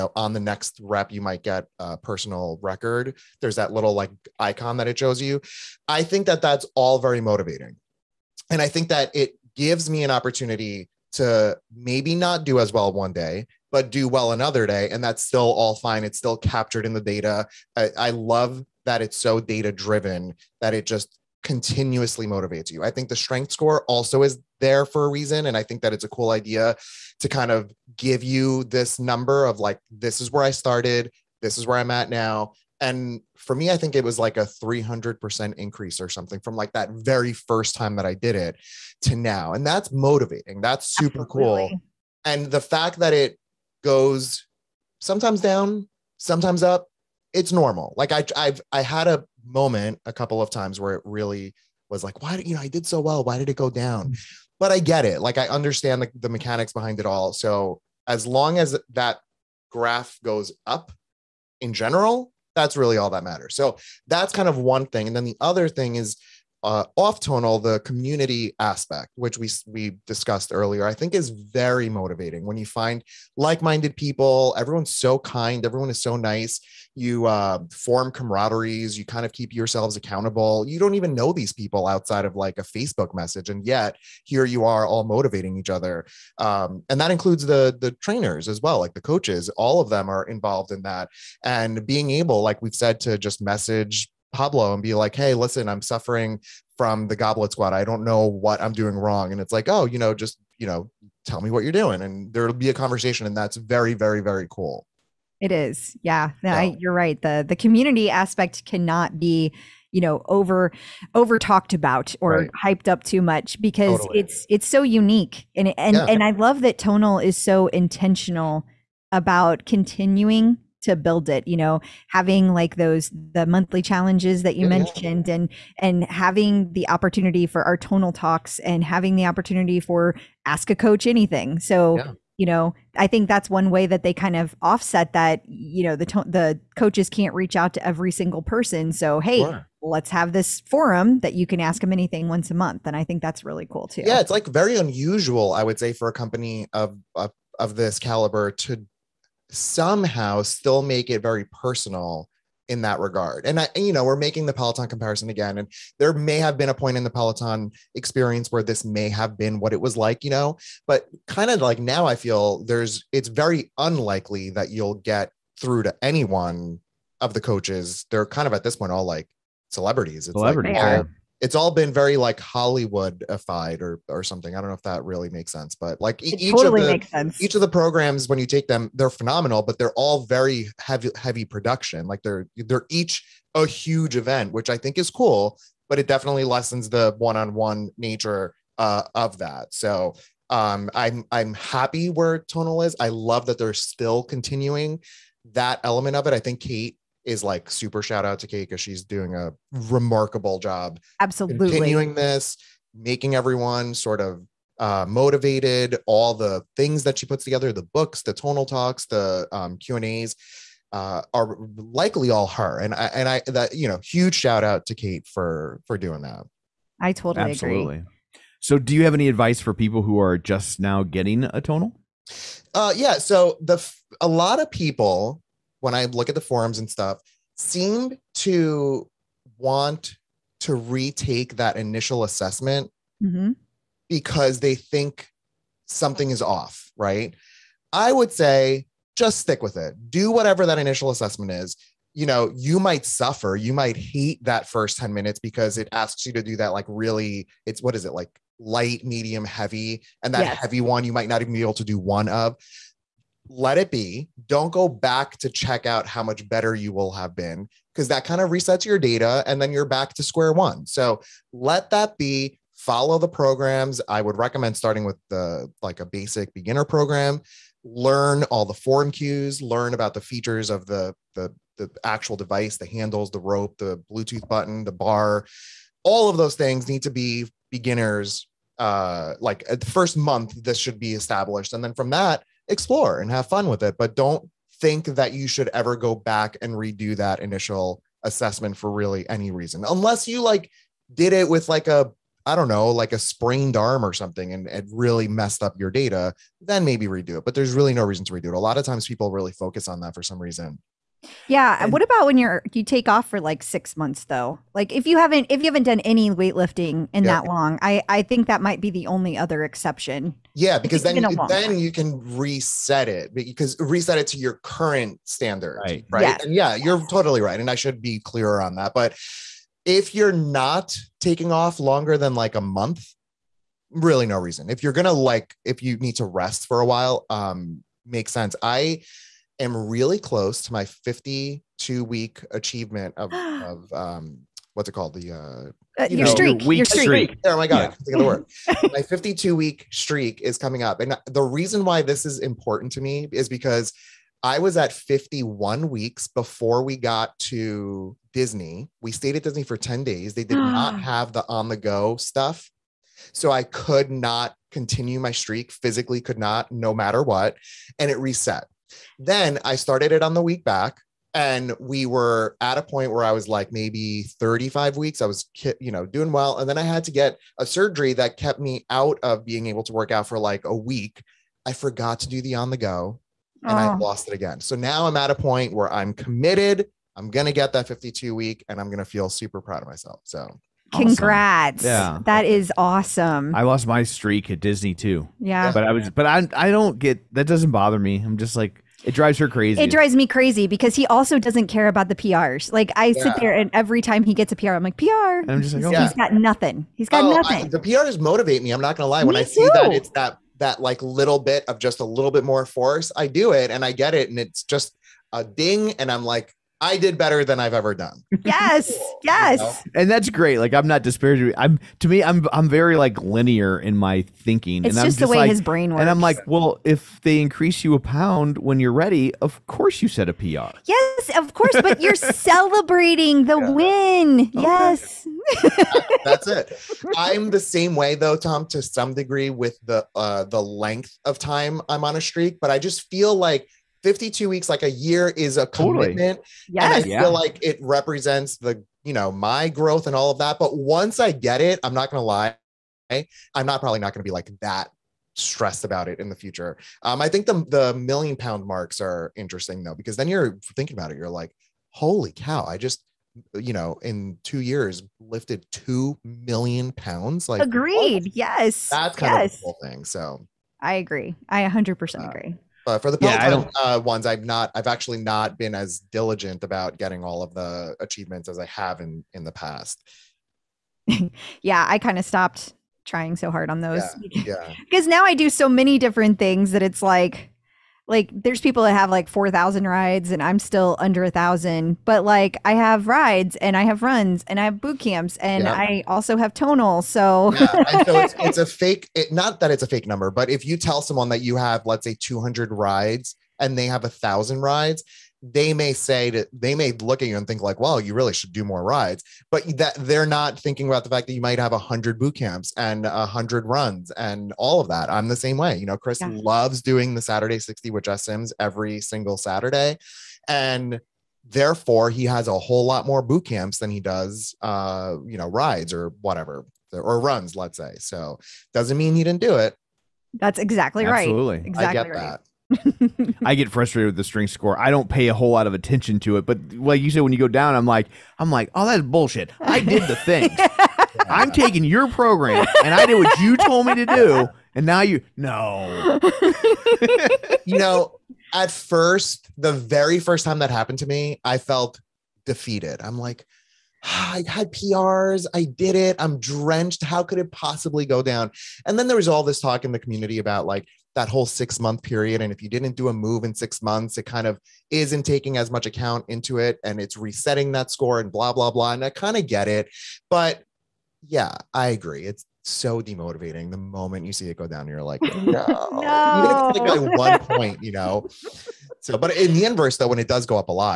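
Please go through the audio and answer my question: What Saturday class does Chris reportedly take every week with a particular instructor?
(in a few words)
Saturday 60.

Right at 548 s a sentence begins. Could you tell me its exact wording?
And then there was all this talk in the community about like that whole six month period.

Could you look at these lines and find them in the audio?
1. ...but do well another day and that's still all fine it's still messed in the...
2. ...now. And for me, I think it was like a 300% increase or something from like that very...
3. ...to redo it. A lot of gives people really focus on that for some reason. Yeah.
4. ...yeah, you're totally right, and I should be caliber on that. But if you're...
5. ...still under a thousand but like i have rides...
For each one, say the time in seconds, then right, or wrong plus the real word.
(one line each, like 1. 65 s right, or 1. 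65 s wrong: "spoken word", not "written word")
1. 13 s wrong: "captured", not "messed"
2. 32 s right
3. 298 s wrong: "times", not "gives"
4. 316 s wrong: "clearer", not "caliber"
5. 480 s right.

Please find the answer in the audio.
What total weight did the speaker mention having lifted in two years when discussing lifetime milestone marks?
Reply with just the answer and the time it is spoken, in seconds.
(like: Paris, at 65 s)
2 million pounds, at 455 s.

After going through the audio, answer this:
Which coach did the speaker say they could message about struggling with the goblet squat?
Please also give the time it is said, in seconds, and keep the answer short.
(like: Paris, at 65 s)
Pablo, at 94 s.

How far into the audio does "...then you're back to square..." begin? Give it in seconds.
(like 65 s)
259 s.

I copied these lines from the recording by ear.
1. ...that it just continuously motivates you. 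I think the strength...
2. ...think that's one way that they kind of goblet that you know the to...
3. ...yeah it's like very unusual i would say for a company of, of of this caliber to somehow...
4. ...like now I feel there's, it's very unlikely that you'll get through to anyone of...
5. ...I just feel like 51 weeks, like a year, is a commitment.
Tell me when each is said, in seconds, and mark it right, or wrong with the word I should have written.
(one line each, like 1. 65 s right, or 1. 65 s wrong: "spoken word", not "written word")
1. 20 s right
2. 133 s wrong: "offset", not "goblet"
3. 144 s right
4. 161 s right
5. 432 s wrong: "52", not "51".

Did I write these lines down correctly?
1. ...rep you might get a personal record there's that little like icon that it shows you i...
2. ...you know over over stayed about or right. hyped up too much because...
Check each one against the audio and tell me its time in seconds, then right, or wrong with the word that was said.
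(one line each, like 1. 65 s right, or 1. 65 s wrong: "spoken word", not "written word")
1. 0 s right
2. 109 s wrong: "talked", not "stayed".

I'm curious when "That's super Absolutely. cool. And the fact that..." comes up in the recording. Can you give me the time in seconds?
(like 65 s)
40 s.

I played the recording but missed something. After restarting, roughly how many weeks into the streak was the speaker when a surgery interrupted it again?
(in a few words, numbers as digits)
35.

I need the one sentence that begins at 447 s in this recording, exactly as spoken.
Um, I think the, the million pound marks are interesting though, because then you're thinking about it.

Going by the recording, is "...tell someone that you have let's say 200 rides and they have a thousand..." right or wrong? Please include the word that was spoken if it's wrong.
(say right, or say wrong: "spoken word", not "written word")
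right.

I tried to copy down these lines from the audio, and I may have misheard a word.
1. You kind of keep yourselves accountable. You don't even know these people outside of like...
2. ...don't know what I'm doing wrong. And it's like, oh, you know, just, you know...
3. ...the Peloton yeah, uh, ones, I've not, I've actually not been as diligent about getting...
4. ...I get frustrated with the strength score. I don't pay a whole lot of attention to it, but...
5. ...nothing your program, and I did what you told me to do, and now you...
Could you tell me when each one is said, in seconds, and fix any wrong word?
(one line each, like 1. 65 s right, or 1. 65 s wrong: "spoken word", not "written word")
1. 78 s right
2. 97 s right
3. 463 s right
4. 523 s right
5. 531 s wrong: "taking", not "nothing".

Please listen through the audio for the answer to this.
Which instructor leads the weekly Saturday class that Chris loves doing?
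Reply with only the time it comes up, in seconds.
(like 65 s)
508 s.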